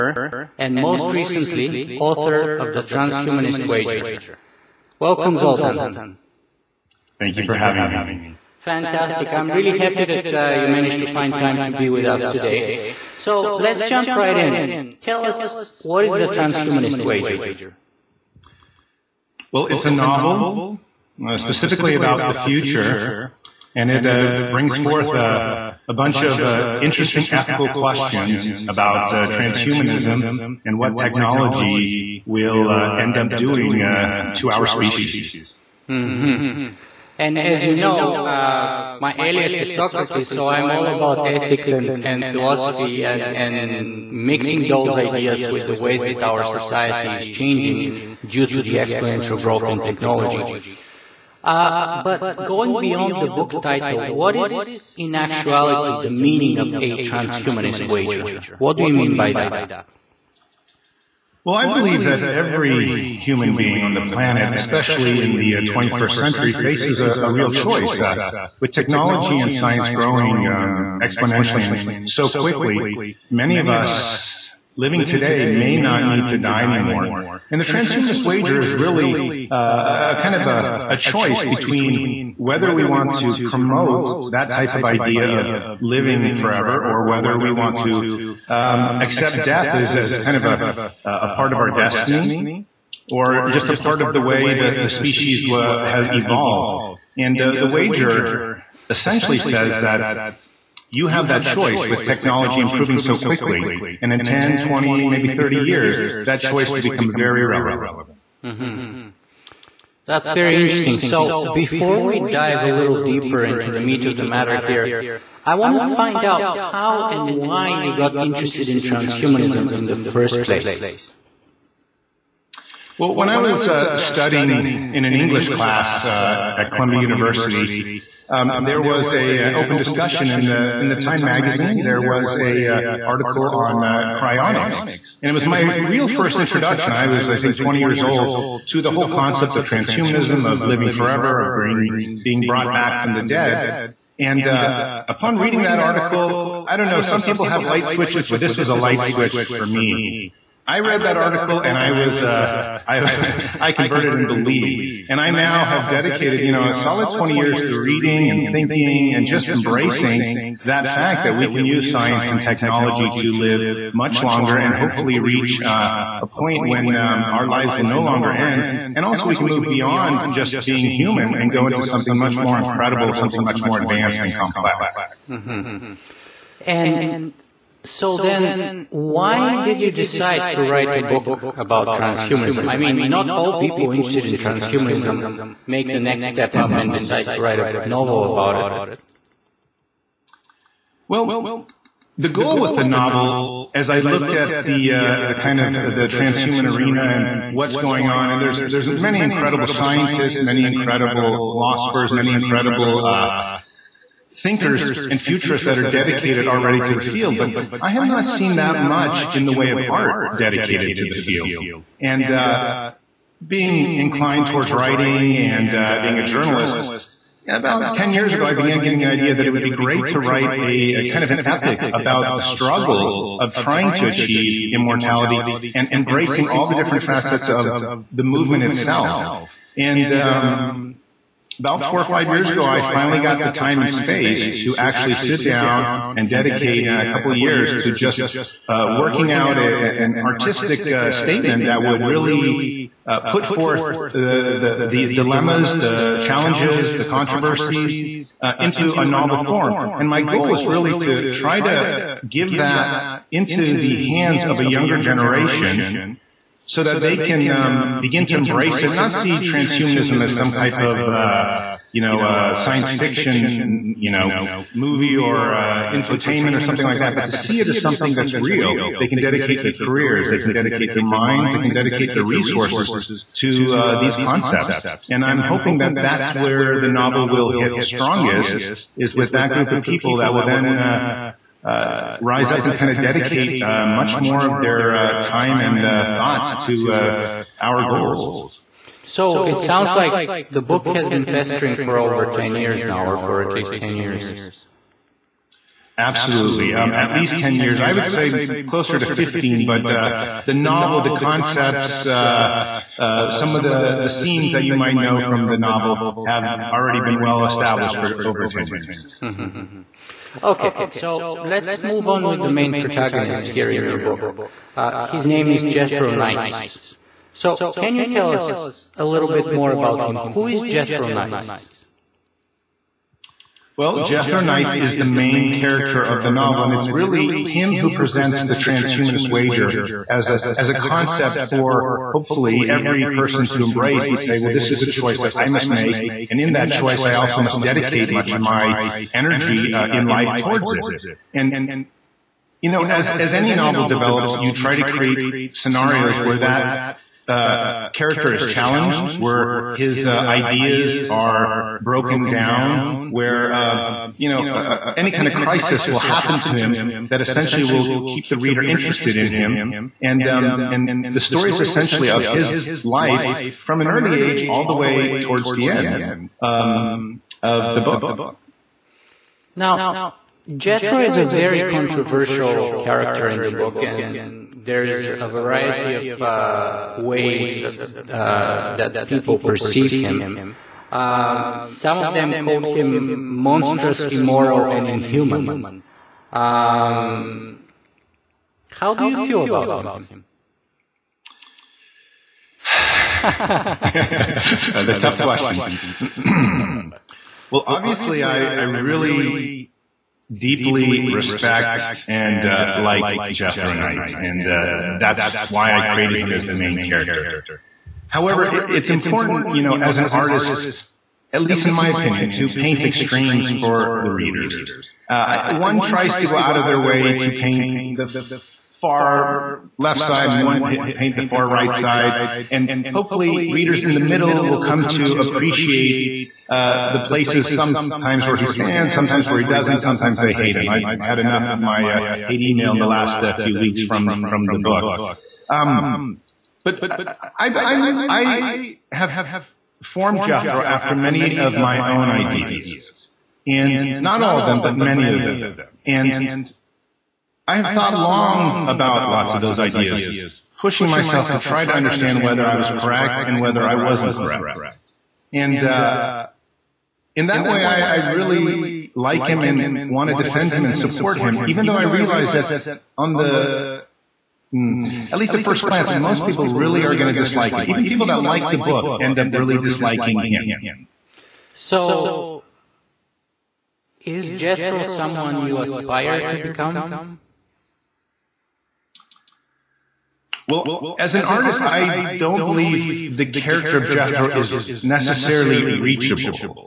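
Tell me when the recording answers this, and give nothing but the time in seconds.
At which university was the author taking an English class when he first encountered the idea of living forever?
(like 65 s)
126 s.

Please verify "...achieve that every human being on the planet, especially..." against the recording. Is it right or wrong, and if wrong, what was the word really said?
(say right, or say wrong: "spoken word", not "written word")
wrong: "believe", not "achieve".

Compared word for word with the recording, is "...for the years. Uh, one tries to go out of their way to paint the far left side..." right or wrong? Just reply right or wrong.
wrong.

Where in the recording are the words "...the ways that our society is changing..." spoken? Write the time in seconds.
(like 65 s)
45 s.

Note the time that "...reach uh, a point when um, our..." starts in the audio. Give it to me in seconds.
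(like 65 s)
165 s.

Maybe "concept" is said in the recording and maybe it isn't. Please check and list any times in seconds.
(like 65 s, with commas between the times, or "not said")
139 s, 274 s, 301 s, 330 s.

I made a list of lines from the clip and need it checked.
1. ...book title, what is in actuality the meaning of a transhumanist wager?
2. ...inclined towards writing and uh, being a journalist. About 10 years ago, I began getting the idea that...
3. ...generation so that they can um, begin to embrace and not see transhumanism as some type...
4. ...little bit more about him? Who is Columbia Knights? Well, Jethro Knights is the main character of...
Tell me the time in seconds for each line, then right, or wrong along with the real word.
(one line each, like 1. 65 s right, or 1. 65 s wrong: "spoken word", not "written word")
1. 53 s right
2. 213 s right
3. 254 s right
4. 319 s wrong: "Jethro", not "Columbia".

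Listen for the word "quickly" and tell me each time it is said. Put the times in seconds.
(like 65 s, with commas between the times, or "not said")
72 s, 103 s.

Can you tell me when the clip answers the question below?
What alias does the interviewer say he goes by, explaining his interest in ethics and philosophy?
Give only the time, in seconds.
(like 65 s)
39 s.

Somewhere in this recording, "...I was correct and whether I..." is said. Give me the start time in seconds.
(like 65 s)
452 s.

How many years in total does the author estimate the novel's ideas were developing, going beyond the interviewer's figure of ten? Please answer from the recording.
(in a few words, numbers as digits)
15.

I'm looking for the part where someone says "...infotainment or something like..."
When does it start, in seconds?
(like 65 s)
265 s.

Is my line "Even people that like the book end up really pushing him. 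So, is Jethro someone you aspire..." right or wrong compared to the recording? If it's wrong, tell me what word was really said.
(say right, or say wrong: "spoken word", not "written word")
wrong: "disliking", not "pushing".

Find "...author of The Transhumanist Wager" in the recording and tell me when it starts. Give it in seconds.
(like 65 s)
1 s.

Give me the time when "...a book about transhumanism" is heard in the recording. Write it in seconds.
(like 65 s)
180 s.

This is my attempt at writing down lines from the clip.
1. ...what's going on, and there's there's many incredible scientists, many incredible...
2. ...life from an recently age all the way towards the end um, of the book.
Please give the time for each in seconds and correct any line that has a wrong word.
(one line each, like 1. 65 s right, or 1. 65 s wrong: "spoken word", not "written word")
1. 197 s right
2. 362 s wrong: "early", not "recently".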